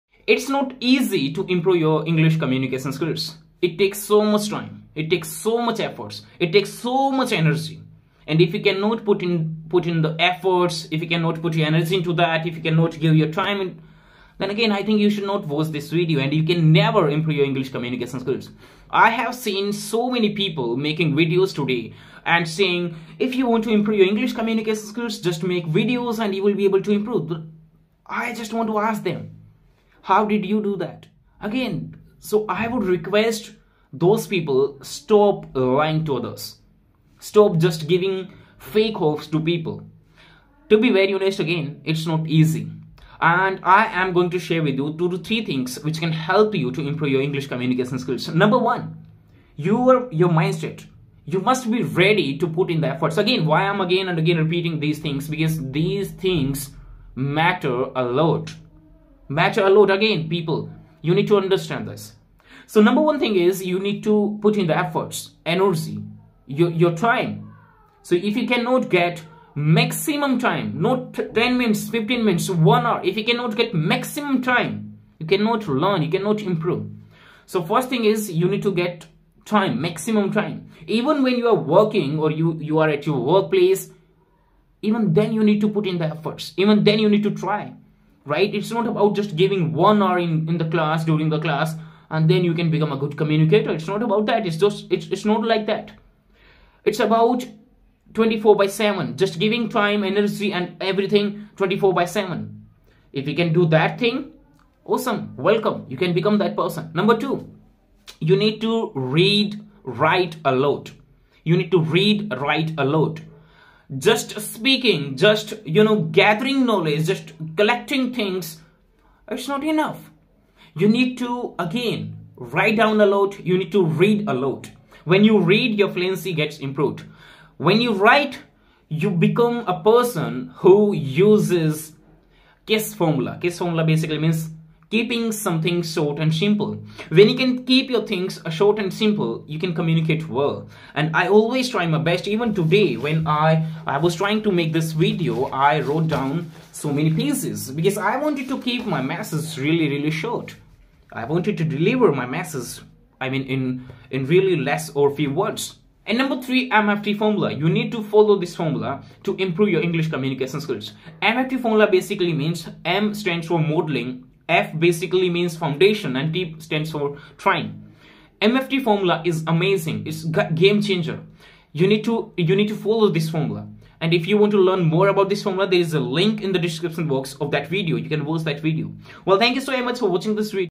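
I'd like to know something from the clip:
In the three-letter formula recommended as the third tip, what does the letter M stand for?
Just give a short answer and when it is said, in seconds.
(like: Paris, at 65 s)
modeling, at 163 s.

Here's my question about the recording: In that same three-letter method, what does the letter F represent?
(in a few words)
foundation.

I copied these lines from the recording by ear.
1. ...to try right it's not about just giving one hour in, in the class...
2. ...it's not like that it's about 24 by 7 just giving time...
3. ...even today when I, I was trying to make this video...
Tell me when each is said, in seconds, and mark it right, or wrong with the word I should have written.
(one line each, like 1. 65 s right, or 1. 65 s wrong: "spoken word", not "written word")
1. 87 s right
2. 95 s right
3. 142 s right.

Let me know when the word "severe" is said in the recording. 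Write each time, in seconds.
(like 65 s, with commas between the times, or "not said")
not said.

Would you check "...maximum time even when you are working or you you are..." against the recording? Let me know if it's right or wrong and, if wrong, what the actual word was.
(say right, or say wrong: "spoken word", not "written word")
right.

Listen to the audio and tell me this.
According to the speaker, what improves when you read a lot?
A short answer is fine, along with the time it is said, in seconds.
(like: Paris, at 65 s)
fluency, at 125 s.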